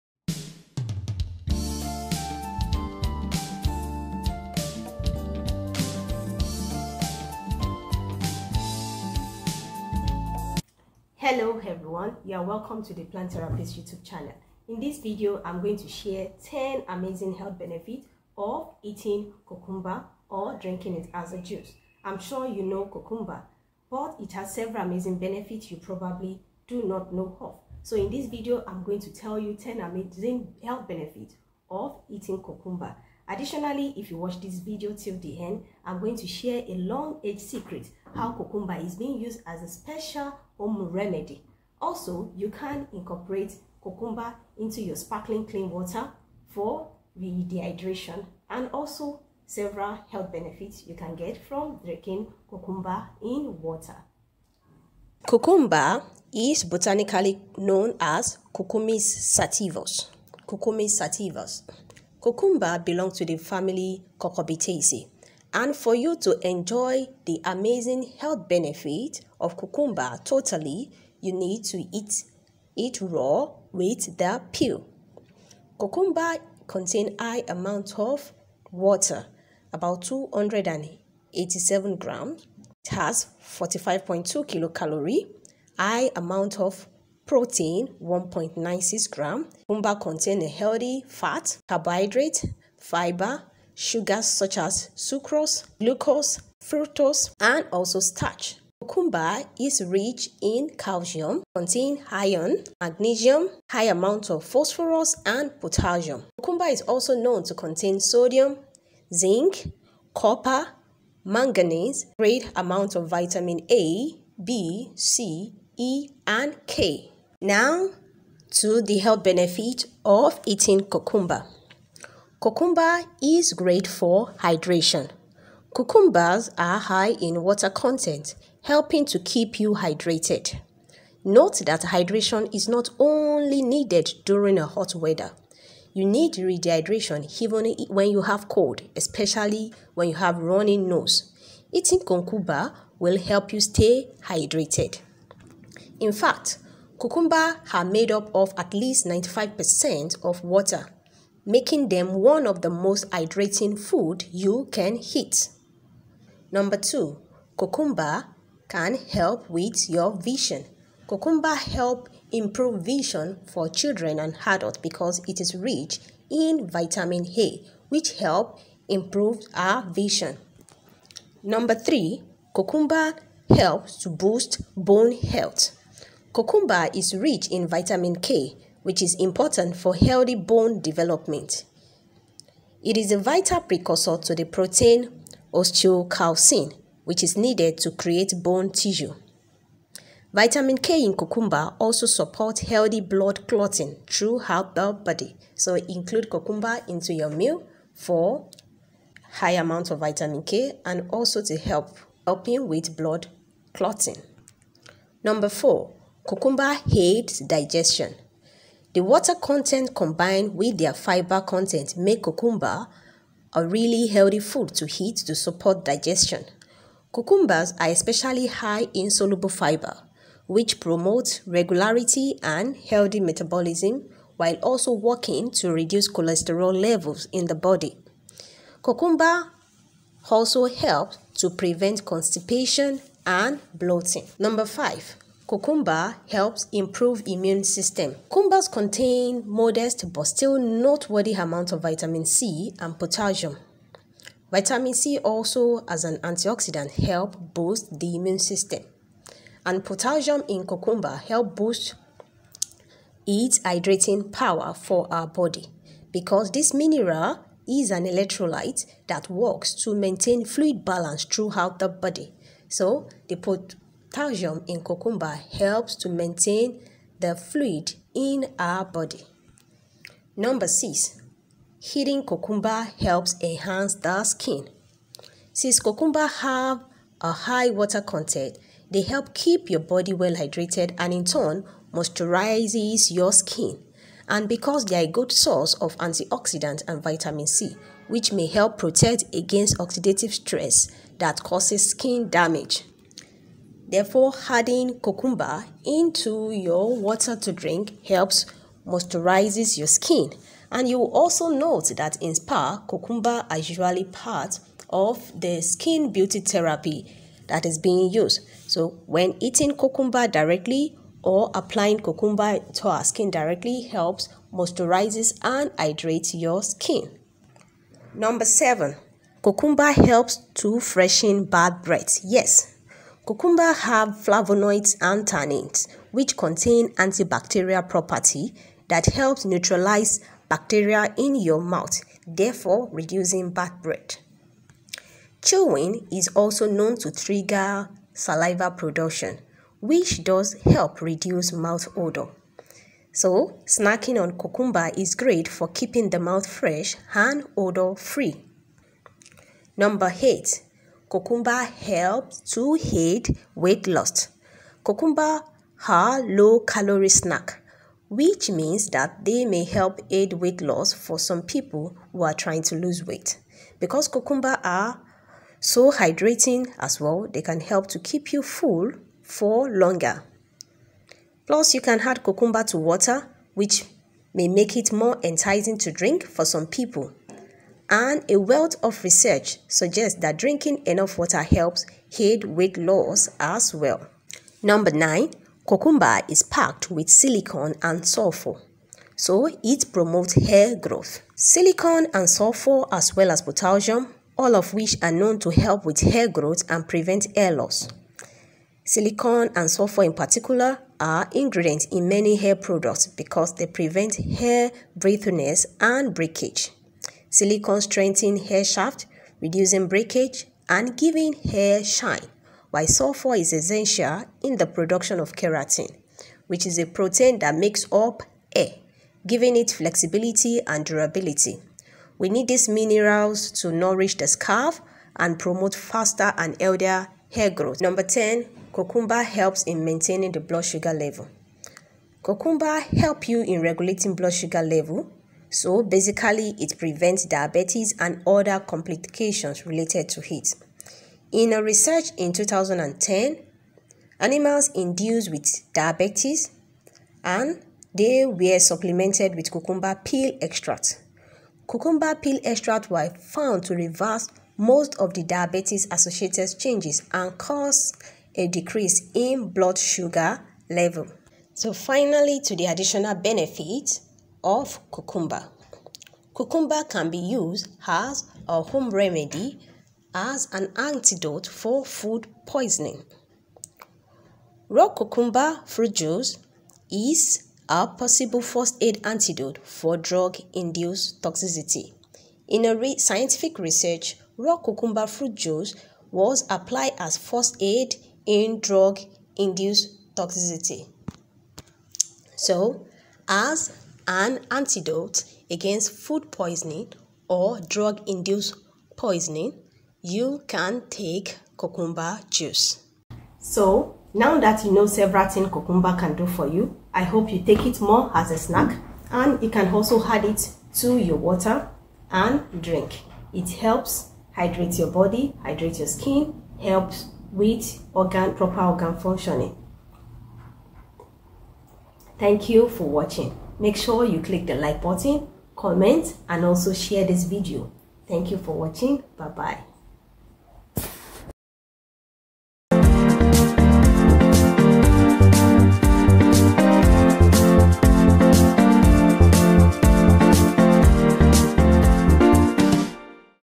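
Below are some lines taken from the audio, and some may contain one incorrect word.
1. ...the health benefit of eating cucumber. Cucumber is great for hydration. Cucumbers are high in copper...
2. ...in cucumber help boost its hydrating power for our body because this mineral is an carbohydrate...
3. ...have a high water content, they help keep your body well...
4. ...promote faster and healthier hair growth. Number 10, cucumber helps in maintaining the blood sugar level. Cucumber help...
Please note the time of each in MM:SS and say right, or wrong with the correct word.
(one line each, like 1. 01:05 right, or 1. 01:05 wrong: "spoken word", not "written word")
1. 01:58 wrong: "water", not "copper"
2. 04:10 wrong: "electrolyte", not "carbohydrate"
3. 04:36 right
4. 07:05 right.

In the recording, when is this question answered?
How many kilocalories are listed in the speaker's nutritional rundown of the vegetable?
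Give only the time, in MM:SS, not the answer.
01:23.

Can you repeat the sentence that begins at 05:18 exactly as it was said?
Number seven, cucumber helps to freshen bad breath.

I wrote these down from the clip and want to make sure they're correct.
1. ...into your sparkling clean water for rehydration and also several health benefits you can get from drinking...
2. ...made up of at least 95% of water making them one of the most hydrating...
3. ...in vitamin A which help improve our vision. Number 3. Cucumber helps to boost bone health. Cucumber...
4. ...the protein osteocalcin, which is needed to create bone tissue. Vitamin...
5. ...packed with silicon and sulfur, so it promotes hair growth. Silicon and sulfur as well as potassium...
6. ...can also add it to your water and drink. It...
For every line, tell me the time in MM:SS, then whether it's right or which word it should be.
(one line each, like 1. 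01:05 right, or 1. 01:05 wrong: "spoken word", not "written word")
1. 00:44 right
2. 02:27 right
3. 02:46 right
4. 03:04 right
5. 06:26 right
6. 08:29 right.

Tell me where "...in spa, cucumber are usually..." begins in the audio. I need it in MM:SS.
05:02.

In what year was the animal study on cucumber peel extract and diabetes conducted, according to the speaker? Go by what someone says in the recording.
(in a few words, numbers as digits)
2010.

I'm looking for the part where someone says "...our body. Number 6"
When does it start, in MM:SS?
04:28.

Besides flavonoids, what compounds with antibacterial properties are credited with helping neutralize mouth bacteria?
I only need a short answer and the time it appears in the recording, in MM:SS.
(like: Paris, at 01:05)
tannins, at 05:25.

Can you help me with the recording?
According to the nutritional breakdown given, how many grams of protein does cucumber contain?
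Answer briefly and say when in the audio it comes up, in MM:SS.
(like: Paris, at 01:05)
1.96 grams, at 01:28.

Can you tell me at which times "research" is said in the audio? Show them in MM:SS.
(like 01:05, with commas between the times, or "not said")
06:19, 07:21, 08:03.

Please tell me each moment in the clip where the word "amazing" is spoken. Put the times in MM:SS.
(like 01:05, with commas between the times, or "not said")
00:16, 00:24, 00:29, 01:07.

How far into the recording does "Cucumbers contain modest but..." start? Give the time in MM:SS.
03:58.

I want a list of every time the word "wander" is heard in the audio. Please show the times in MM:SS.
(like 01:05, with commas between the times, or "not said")
not said.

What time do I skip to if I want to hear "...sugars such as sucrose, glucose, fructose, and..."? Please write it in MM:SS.
01:33.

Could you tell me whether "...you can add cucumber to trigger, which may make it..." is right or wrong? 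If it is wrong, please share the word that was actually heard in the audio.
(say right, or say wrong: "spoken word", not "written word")
wrong: "water", not "trigger".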